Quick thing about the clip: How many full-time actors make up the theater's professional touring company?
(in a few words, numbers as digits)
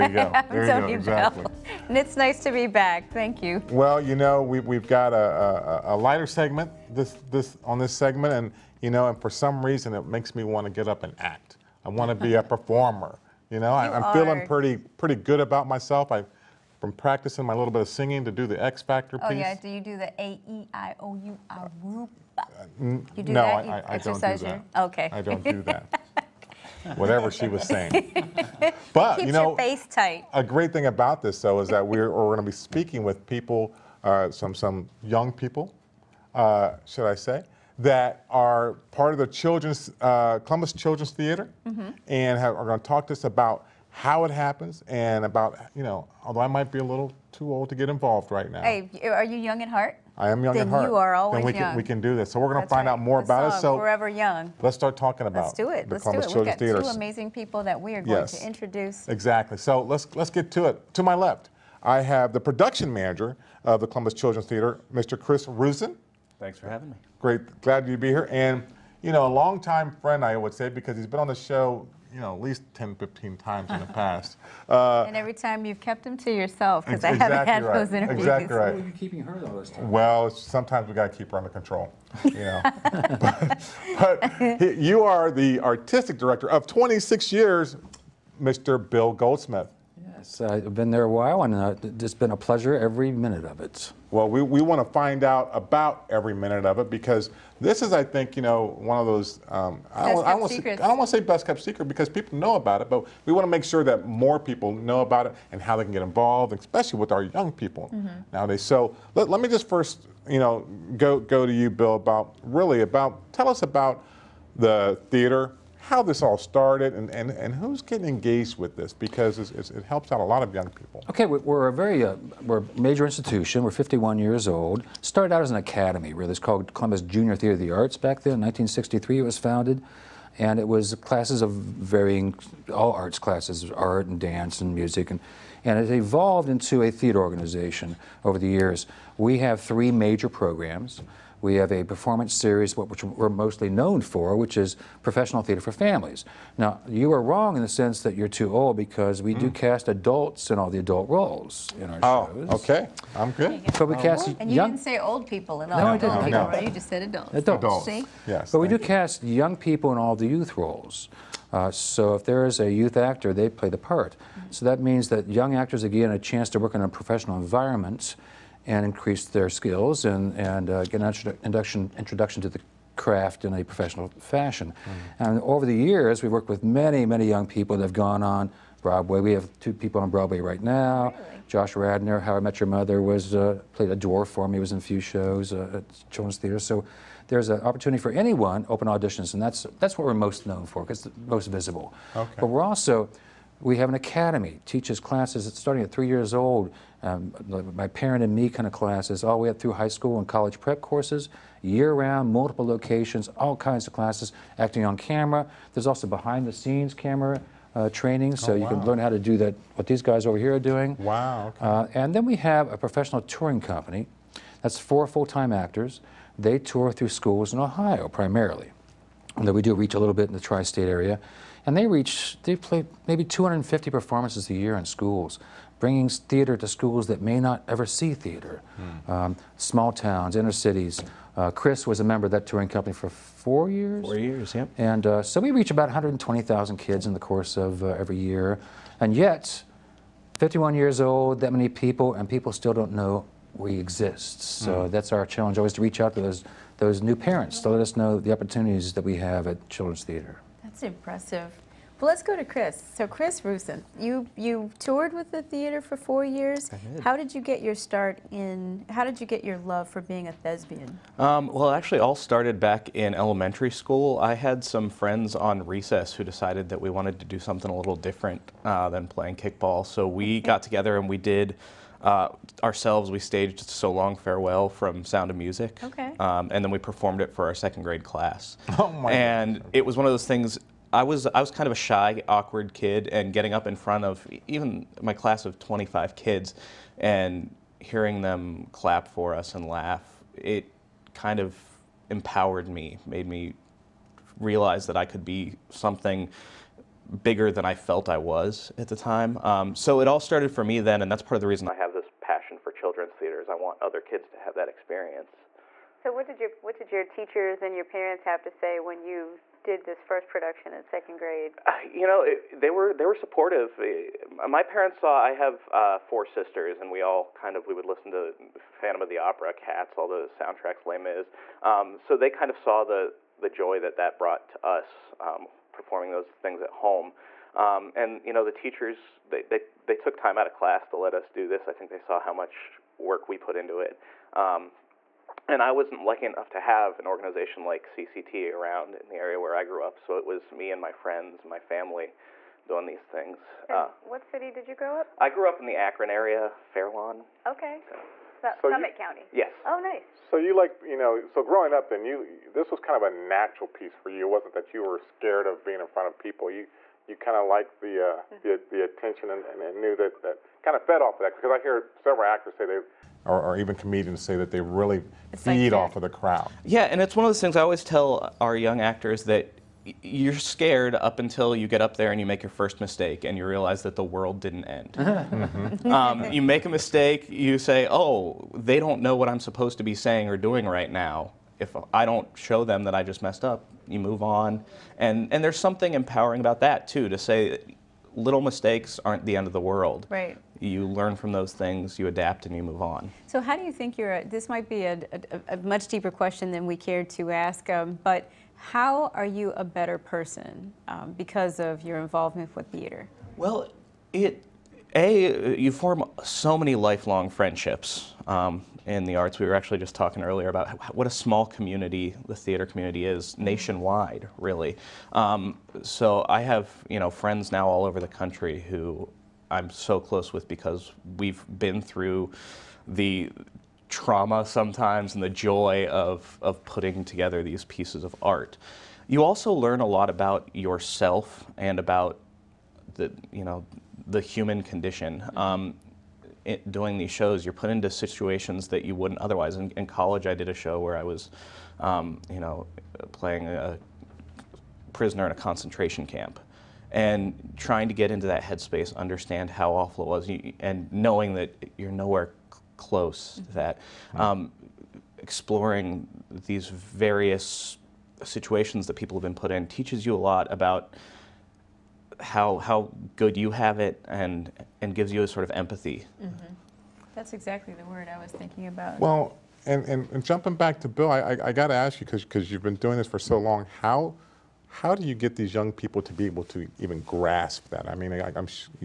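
4.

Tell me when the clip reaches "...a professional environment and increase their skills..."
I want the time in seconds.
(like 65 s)
166 s.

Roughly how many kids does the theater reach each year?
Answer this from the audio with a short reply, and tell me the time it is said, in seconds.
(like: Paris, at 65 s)
120,000, at 235 s.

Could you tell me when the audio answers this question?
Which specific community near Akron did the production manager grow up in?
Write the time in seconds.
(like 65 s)
346 s.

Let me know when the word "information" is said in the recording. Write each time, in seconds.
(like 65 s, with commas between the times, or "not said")
not said.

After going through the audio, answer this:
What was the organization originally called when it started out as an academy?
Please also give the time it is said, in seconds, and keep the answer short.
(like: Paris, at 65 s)
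Columbus Junior Theater of the Arts, at 126 s.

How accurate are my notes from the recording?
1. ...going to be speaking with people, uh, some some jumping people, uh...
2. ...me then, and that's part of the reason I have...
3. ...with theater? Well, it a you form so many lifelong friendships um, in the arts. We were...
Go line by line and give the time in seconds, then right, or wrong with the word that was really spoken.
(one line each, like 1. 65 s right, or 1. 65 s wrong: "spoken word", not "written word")
1. 32 s wrong: "young", not "jumping"
2. 300 s right
3. 402 s right.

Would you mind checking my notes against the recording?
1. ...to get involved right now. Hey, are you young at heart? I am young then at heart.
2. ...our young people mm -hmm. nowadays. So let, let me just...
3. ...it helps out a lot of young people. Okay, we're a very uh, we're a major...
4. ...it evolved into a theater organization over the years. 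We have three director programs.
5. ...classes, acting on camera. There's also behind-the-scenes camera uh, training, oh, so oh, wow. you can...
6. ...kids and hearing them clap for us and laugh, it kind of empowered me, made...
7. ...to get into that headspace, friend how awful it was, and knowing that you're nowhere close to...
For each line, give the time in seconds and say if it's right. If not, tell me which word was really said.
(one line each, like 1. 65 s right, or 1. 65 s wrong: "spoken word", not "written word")
1. 47 s right
2. 107 s right
3. 119 s right
4. 135 s wrong: "major", not "director"
5. 203 s right
6. 286 s right
7. 447 s wrong: "understand", not "friend".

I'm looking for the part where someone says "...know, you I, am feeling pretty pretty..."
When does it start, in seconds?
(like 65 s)
13 s.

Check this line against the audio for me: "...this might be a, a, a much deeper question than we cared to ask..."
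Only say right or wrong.
right.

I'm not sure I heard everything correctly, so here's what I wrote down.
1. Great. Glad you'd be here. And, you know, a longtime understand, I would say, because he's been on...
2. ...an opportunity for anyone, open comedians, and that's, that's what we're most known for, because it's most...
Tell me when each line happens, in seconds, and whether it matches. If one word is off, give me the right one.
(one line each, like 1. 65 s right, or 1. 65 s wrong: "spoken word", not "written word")
1. 67 s wrong: "friend", not "understand"
2. 187 s wrong: "auditions", not "comedians".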